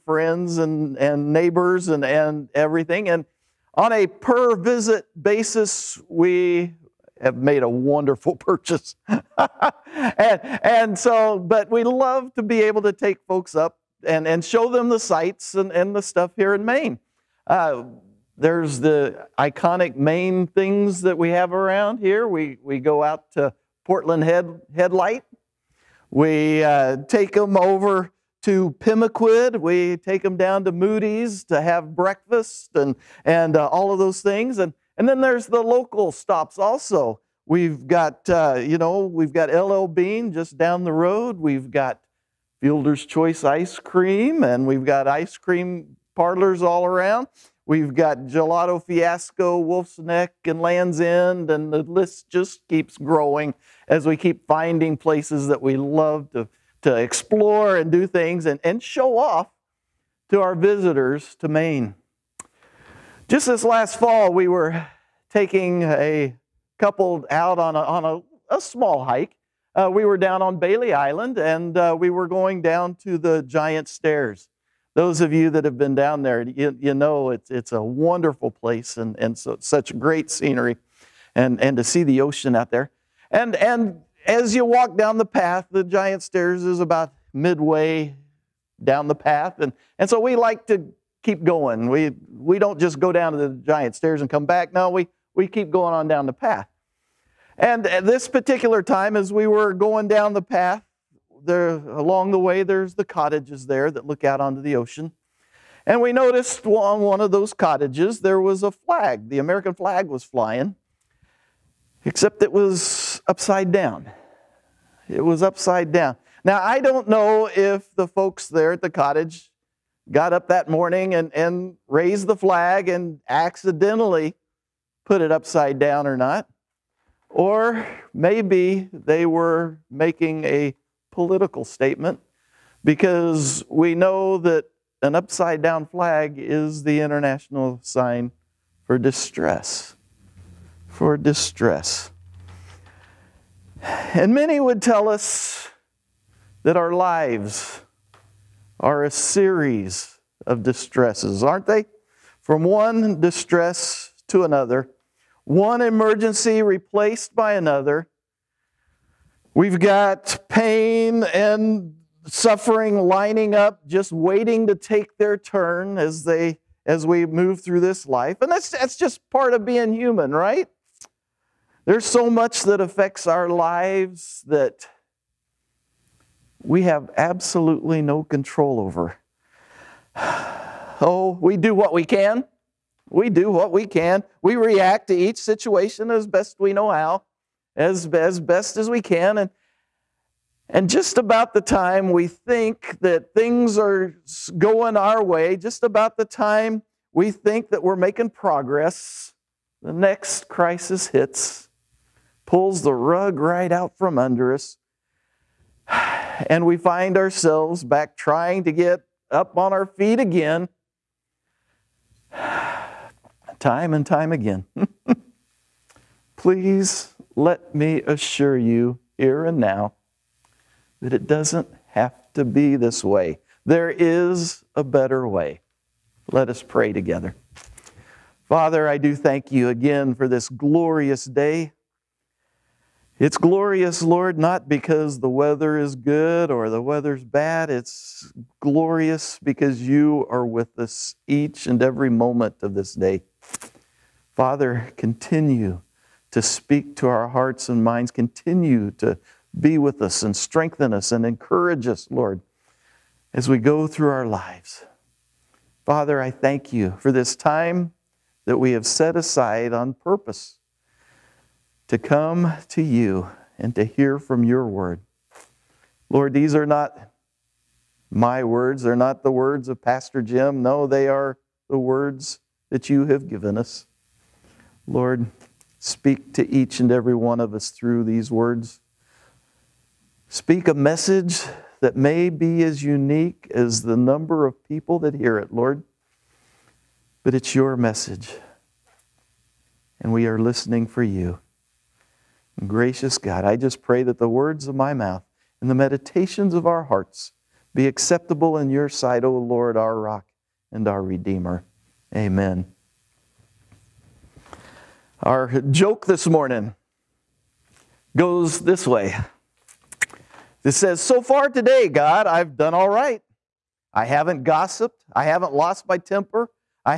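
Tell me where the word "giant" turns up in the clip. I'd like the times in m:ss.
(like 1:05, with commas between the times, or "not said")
1:13, 1:25, 1:33.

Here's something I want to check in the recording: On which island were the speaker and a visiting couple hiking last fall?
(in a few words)
Bailey Island.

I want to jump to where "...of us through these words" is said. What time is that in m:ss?
4:37.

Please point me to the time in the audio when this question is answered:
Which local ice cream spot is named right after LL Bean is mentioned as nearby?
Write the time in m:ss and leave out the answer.
0:42.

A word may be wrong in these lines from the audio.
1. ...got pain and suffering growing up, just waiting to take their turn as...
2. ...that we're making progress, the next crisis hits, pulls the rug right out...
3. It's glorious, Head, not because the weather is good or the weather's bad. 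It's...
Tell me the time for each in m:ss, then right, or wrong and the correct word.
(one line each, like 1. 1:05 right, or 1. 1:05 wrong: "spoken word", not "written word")
1. 2:39 wrong: "lining", not "growing"
2. 3:17 right
3. 3:53 wrong: "Lord", not "Head".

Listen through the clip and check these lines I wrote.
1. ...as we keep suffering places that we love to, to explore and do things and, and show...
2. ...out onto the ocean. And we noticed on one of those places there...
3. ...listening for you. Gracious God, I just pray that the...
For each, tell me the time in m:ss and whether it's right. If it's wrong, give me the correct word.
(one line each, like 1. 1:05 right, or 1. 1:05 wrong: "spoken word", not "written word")
1. 0:53 wrong: "finding", not "suffering"
2. 1:44 wrong: "cottages", not "places"
3. 4:50 right.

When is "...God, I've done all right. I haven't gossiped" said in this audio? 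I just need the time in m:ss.
5:11.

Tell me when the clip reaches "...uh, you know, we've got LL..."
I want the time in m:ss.
0:38.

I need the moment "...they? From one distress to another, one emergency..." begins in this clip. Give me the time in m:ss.
2:31.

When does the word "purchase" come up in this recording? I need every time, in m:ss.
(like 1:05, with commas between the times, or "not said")
0:08.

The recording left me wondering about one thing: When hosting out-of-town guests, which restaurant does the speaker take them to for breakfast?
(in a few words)
Moody's.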